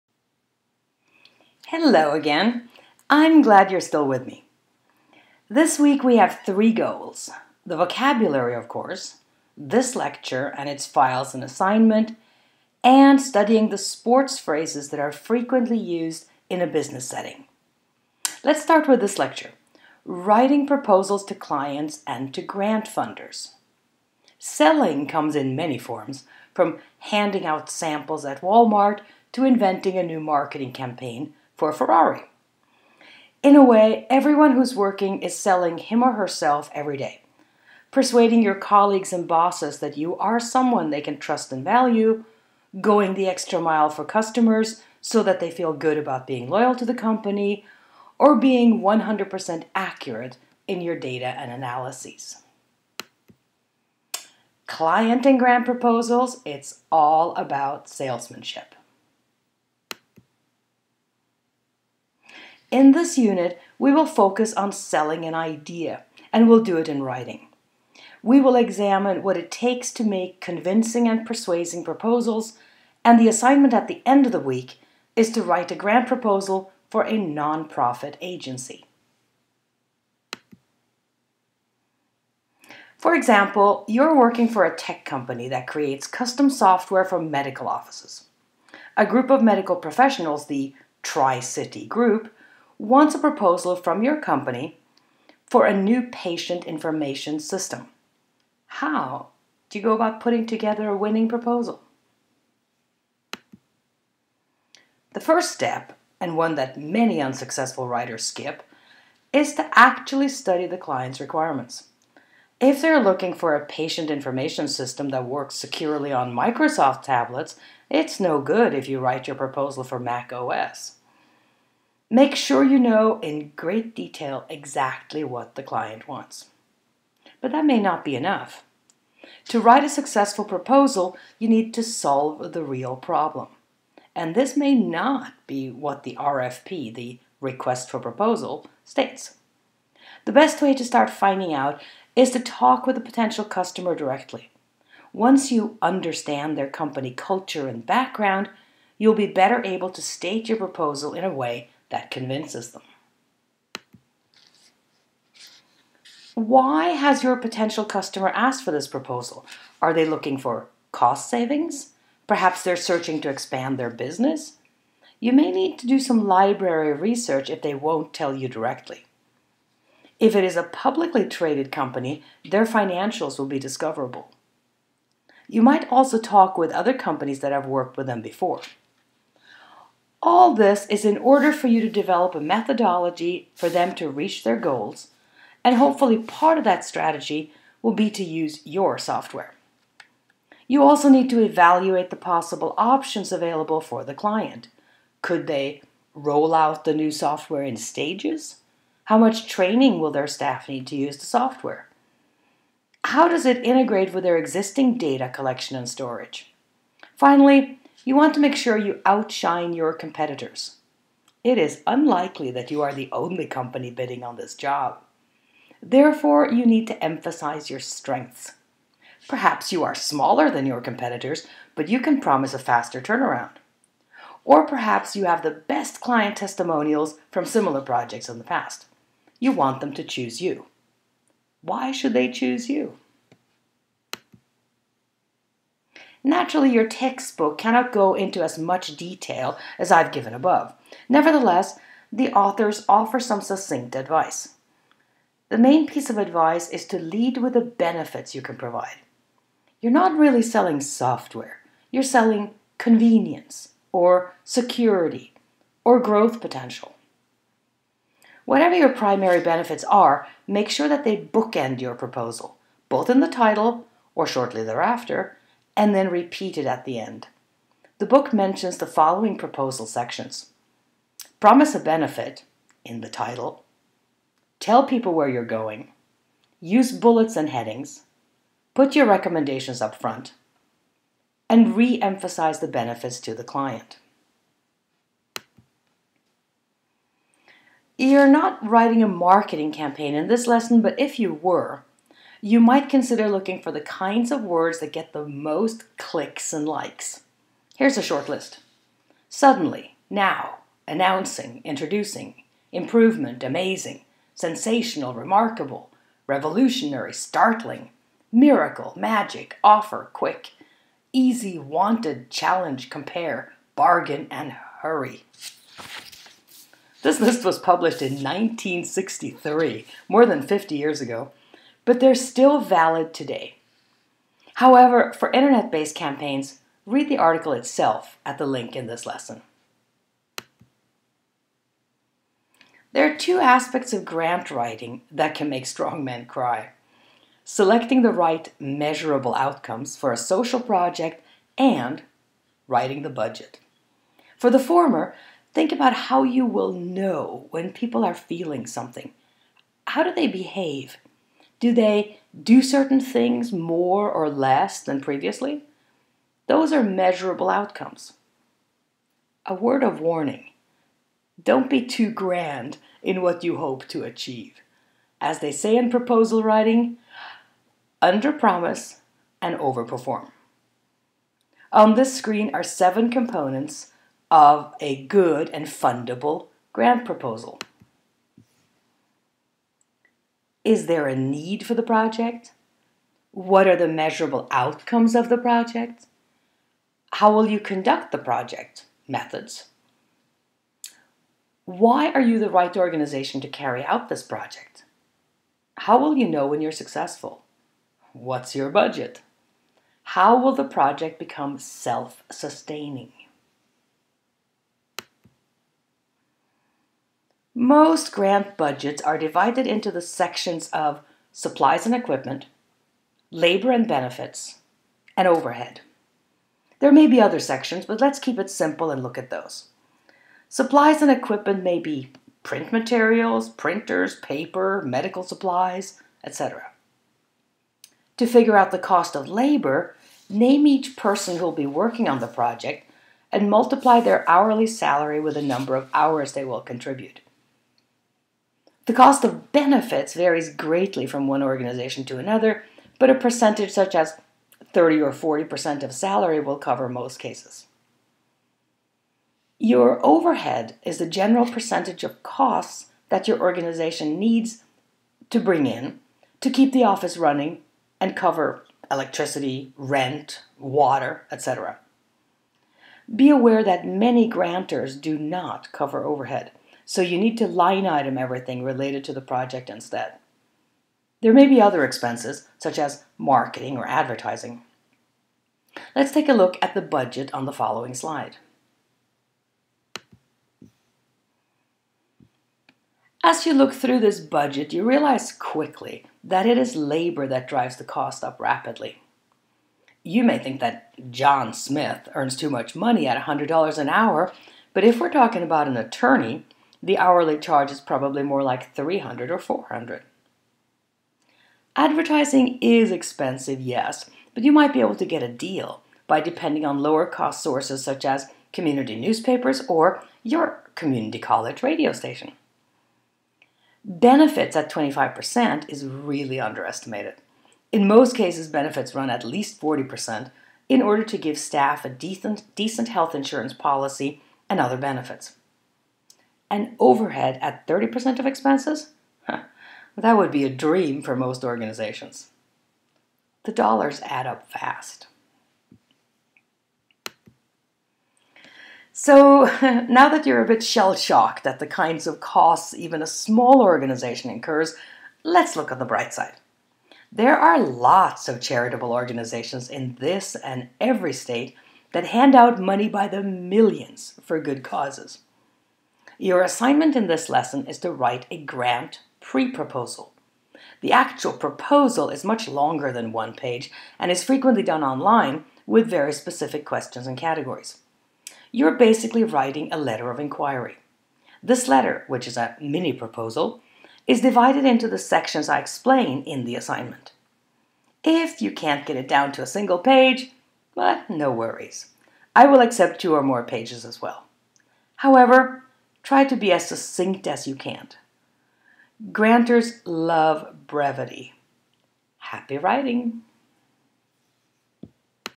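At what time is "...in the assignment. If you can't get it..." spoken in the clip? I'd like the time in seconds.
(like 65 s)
576 s.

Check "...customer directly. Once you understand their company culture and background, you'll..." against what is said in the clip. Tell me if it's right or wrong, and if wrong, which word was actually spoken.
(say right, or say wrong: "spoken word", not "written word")
right.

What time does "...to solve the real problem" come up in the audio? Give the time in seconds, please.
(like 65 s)
131 s.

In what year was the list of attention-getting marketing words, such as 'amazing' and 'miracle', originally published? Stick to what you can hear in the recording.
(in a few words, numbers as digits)
1963.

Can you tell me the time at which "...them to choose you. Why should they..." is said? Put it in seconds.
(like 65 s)
229 s.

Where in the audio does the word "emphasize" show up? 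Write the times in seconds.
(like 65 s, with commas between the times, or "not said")
217 s, 282 s.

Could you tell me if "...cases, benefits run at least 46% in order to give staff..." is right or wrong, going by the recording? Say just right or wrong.
wrong.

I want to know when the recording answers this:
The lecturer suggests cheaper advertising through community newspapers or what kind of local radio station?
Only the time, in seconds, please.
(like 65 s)
510 s.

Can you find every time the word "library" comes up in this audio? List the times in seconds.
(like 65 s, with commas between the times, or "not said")
166 s.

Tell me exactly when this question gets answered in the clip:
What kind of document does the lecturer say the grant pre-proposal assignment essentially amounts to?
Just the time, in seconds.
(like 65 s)
569 s.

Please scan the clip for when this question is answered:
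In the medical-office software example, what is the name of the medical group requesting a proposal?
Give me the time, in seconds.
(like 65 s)
91 s.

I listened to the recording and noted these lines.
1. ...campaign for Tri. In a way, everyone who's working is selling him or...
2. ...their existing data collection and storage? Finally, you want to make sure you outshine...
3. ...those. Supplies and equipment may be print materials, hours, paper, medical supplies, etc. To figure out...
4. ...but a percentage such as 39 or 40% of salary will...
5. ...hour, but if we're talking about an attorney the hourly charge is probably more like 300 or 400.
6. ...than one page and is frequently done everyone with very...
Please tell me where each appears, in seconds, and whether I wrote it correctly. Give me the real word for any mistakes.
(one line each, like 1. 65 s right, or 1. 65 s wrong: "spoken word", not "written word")
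1. 30 s wrong: "Ferrari", not "Tri"
2. 204 s right
3. 419 s wrong: "printers", not "hours"
4. 442 s wrong: "30", not "39"
5. 493 s right
6. 562 s wrong: "online", not "everyone".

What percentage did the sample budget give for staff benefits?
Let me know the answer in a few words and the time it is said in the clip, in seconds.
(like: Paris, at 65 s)
25%, at 514 s.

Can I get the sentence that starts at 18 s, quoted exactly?
Let's start with this lecture writing proposals to clients and to grant funders.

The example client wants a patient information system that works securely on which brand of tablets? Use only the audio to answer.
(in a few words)
Microsoft.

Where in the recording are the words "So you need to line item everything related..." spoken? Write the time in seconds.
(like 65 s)
466 s.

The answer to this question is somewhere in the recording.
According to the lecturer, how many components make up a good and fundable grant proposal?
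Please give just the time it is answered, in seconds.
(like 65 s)
372 s.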